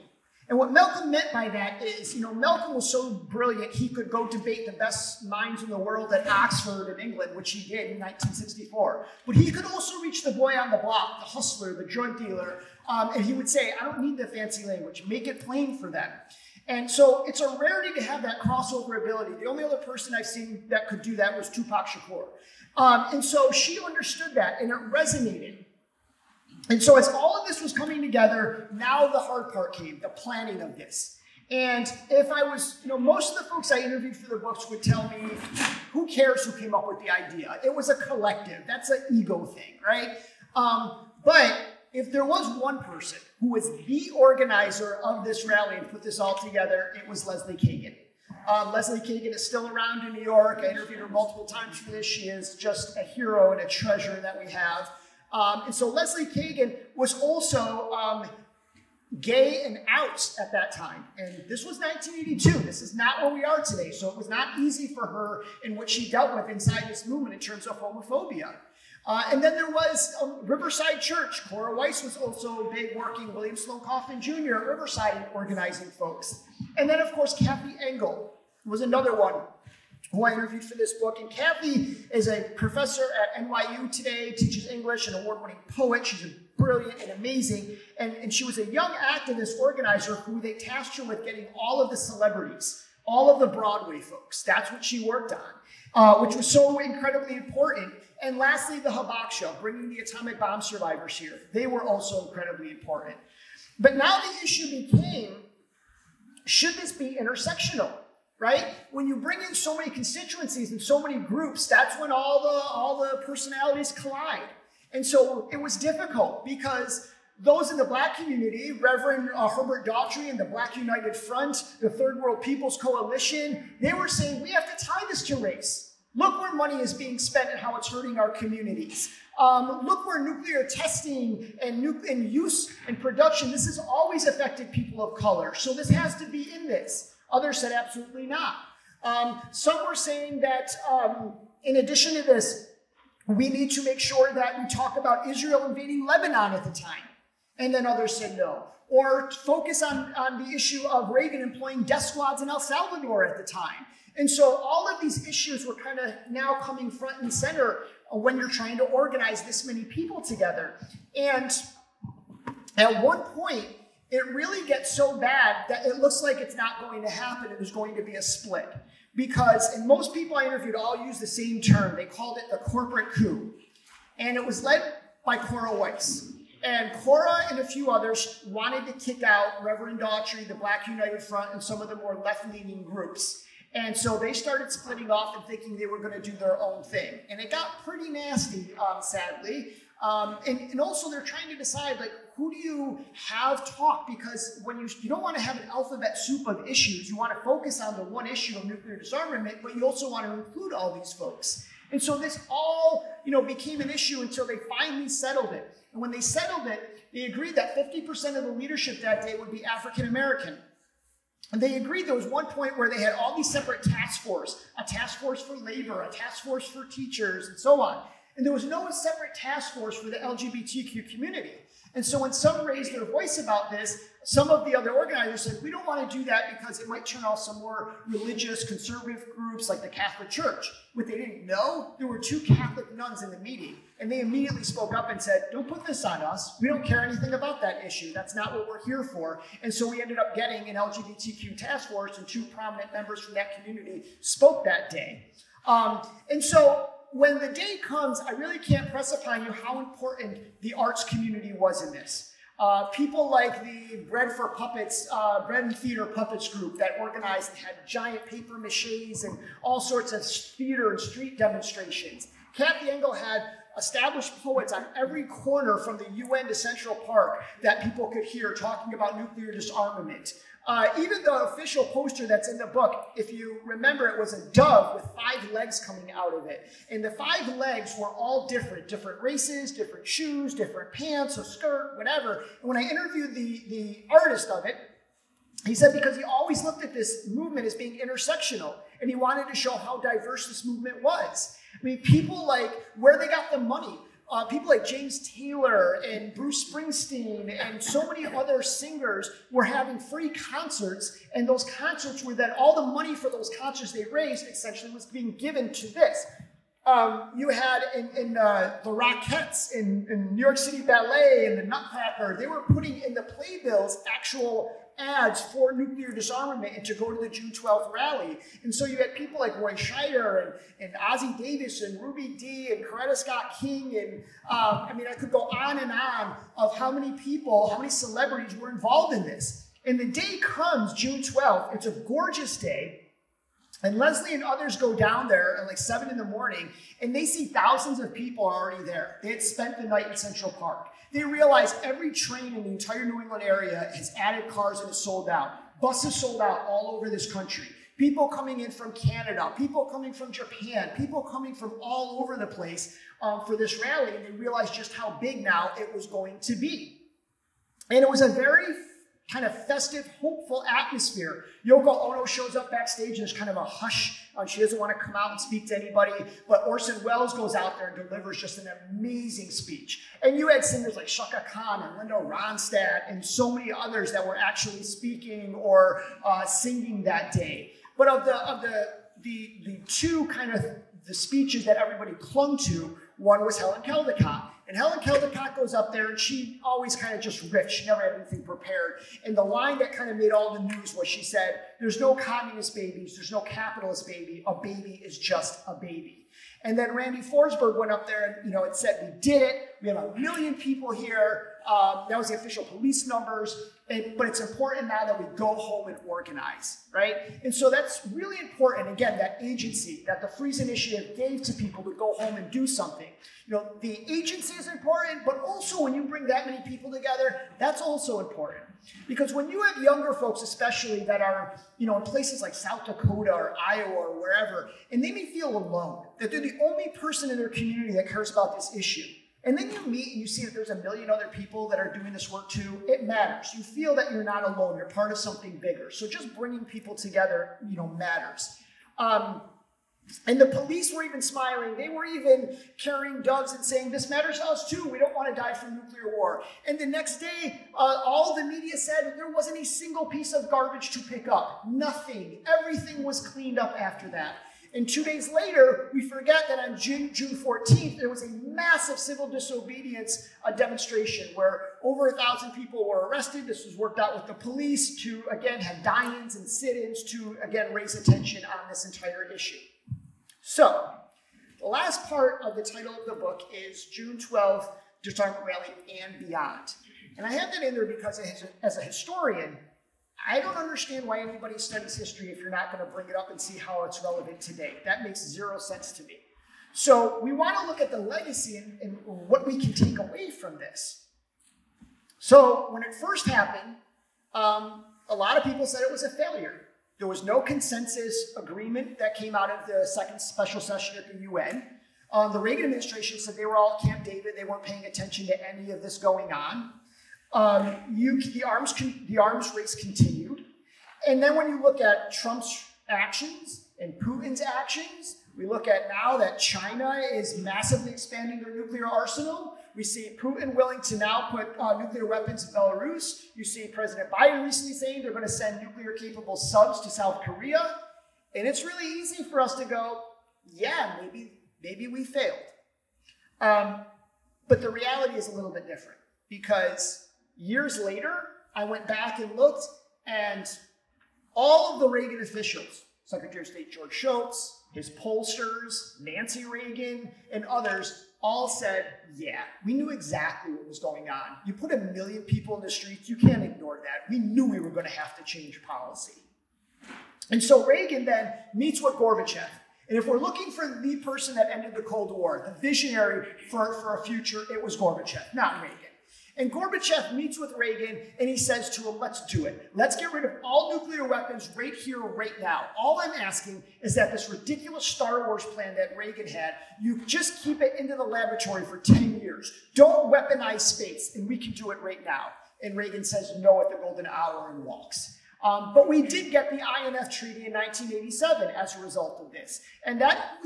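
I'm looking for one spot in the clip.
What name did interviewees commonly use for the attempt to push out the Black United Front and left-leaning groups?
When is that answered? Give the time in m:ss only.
2:52.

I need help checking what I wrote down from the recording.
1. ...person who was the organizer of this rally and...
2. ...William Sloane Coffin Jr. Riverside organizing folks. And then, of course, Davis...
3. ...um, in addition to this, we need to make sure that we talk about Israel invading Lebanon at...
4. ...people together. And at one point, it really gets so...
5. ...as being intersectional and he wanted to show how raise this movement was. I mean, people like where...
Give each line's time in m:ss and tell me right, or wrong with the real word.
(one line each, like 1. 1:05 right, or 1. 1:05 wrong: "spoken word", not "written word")
1. 0:42 right
2. 1:13 wrong: "Kathy", not "Davis"
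3. 2:20 right
4. 2:39 right
5. 4:47 wrong: "diverse", not "raise".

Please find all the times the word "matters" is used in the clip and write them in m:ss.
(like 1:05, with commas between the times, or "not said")
7:13, 7:17, 7:24.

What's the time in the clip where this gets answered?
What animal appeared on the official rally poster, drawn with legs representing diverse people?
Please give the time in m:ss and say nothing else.
4:34.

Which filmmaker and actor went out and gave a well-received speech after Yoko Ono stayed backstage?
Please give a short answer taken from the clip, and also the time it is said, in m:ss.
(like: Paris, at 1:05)
Orson Welles, at 6:06.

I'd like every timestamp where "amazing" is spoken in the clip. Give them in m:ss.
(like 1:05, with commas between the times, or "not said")
1:27, 6:08.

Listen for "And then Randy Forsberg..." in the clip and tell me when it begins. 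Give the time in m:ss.
6:36.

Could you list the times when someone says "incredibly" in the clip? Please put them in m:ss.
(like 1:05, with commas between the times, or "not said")
1:36, 1:42.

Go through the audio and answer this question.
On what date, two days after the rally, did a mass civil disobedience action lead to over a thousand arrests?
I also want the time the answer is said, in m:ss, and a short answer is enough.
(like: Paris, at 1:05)
June 14th, at 7:37.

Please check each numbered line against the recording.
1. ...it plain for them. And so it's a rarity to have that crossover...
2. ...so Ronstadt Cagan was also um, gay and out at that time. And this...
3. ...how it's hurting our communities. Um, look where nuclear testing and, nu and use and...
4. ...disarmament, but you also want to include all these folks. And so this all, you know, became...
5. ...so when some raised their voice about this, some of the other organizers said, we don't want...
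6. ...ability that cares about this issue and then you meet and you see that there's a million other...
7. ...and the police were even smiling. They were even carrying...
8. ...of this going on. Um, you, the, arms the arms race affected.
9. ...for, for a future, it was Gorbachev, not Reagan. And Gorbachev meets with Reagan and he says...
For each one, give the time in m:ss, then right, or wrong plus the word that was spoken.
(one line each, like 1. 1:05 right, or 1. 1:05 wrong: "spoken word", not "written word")
1. 0:15 right
2. 0:55 wrong: "Leslie", not "Ronstadt"
3. 2:07 right
4. 3:18 right
5. 3:42 right
6. 7:07 wrong: "community", not "ability"
7. 7:20 right
8. 8:25 wrong: "continued", not "affected"
9. 9:23 right.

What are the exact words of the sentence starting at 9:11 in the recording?
You put a million people in the streets, you can't ignore that.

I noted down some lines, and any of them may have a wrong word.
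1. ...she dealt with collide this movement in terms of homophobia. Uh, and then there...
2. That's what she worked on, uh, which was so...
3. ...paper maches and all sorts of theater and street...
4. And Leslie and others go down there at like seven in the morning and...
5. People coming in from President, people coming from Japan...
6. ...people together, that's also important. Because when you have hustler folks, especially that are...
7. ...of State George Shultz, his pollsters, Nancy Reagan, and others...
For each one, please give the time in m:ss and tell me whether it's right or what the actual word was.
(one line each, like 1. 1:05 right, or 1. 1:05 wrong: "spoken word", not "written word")
1. 1:05 wrong: "inside", not "collide"
2. 1:34 right
3. 4:18 right
4. 5:33 right
5. 5:47 wrong: "Canada", not "President"
6. 6:56 wrong: "younger", not "hustler"
7. 9:03 right.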